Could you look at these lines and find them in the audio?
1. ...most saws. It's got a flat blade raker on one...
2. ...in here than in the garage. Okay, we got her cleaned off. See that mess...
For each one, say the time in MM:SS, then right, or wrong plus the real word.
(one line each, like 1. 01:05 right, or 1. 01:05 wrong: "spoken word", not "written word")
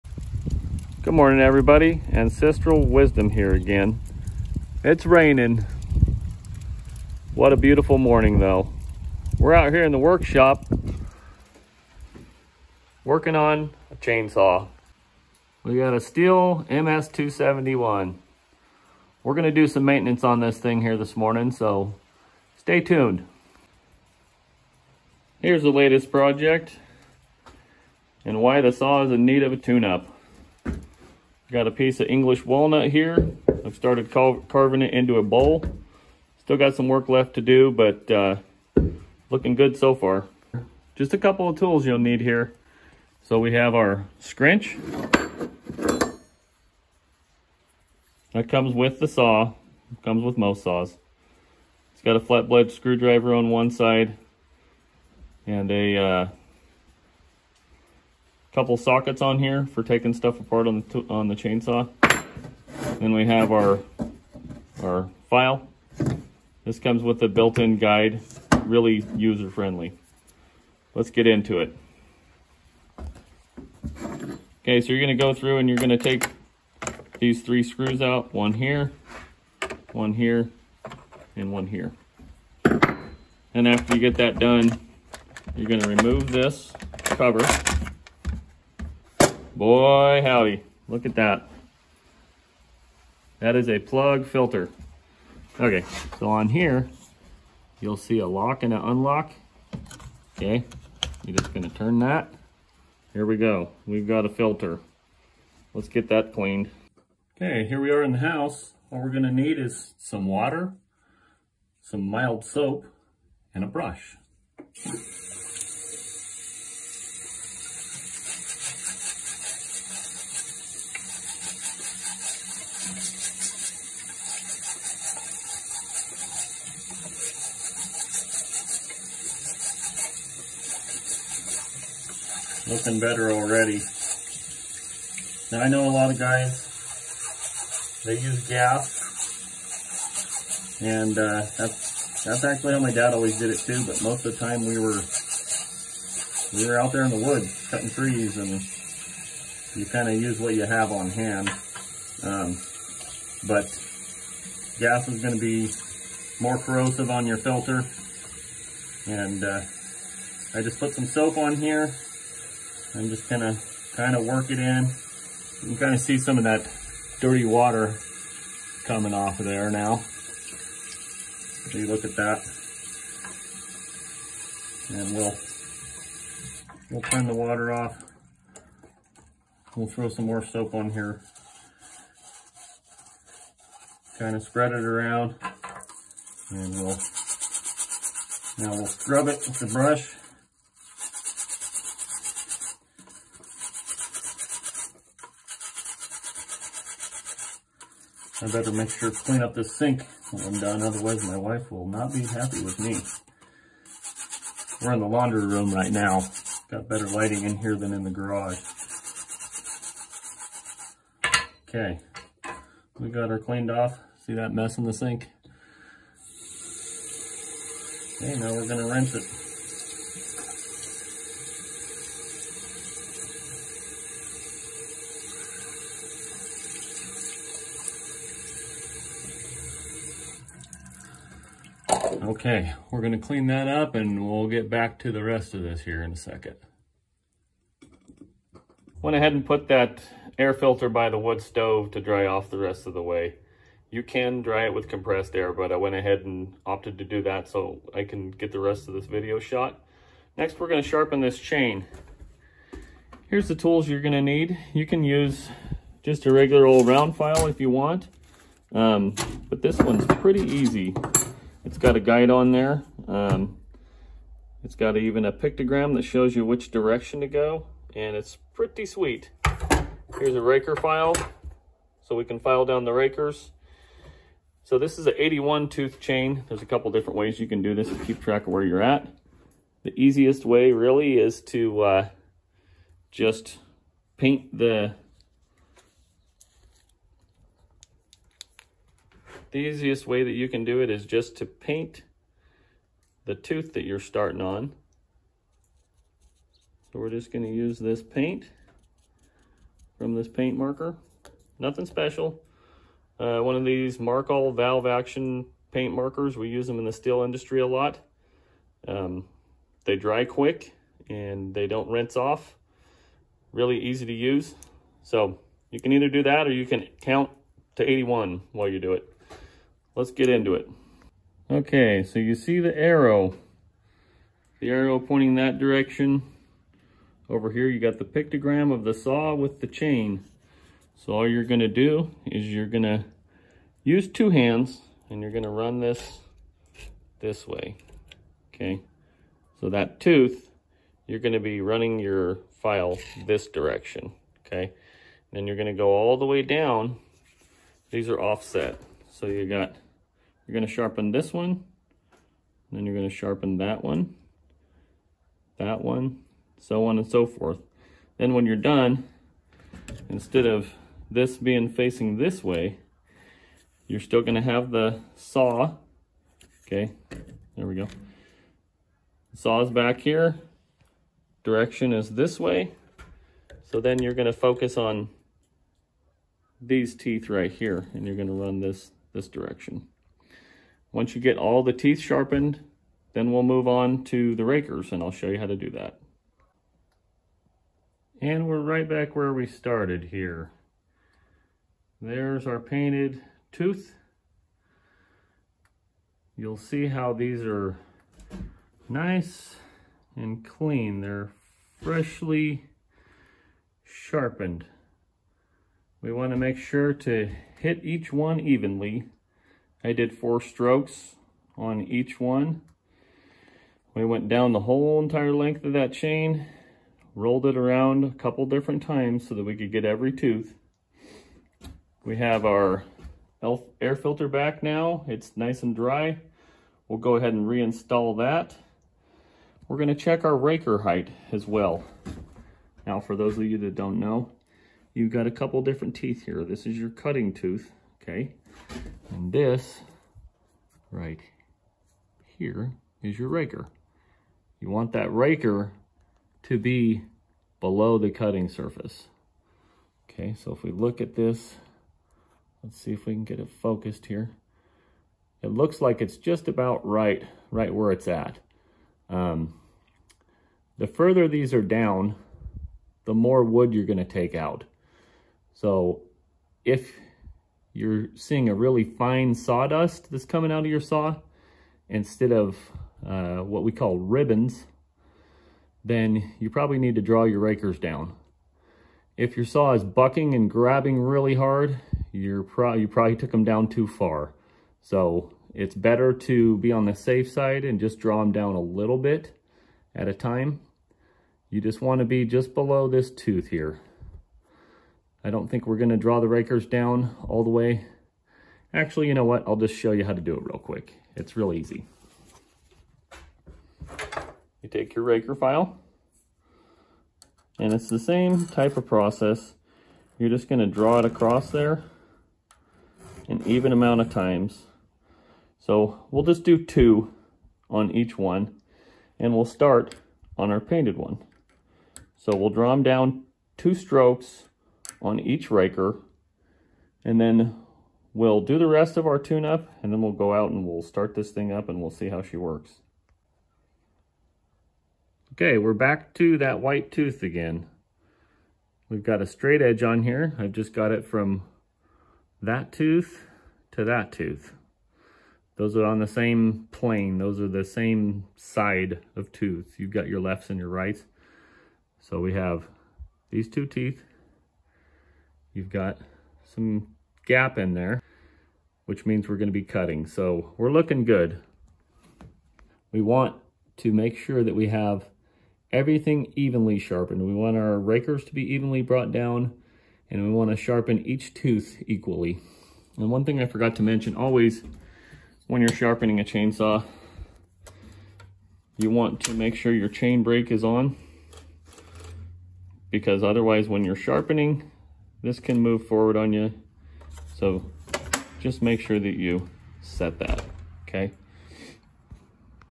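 1. 00:50 wrong: "screwdriver", not "raker"
2. 03:27 right.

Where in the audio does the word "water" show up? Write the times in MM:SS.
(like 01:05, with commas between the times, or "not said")
01:50, 02:47, 02:57.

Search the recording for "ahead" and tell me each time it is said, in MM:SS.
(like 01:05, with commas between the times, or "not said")
03:59, 04:05, 07:07.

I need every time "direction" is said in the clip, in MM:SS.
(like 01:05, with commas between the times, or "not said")
04:26, 05:25, 05:43, 06:11, 06:19.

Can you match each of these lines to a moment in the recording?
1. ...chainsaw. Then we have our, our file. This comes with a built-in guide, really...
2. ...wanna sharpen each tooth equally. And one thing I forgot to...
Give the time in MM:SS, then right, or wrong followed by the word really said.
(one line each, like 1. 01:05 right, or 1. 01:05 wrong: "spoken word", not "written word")
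1. 01:01 right
2. 09:30 right.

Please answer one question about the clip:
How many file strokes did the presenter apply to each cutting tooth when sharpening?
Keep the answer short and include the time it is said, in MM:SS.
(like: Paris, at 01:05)
4, at 06:50.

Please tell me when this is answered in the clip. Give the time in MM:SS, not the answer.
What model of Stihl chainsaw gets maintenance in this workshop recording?
00:16.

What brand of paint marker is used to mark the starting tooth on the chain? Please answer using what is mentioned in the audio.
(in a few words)
Markal.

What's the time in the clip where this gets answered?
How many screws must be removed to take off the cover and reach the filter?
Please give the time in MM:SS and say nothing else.
01:17.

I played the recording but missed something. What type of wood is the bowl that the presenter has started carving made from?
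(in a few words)
English walnut.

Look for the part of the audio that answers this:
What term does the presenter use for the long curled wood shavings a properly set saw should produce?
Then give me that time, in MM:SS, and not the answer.
07:53.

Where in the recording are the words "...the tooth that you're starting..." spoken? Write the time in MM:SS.
04:53.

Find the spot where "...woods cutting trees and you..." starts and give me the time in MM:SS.
02:27.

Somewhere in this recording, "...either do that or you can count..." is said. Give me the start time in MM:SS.
05:15.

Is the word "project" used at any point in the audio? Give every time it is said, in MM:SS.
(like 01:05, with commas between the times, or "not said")
00:26.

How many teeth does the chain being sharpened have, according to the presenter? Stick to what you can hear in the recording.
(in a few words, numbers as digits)
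81.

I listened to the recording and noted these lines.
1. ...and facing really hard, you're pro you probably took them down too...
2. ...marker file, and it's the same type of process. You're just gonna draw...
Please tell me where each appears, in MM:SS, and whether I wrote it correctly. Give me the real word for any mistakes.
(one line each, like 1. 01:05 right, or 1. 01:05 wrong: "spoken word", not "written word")
1. 08:00 wrong: "grabbing", not "facing"
2. 08:25 wrong: "raker", not "marker".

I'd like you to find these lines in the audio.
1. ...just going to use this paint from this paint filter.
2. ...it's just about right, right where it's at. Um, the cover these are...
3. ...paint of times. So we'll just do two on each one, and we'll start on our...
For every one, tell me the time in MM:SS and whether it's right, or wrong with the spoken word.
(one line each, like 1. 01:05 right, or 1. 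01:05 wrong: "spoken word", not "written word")
1. 04:57 wrong: "marker", not "filter"
2. 07:36 wrong: "further", not "cover"
3. 08:33 wrong: "amount", not "paint".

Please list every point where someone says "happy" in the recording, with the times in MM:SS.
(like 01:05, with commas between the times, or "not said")
03:22.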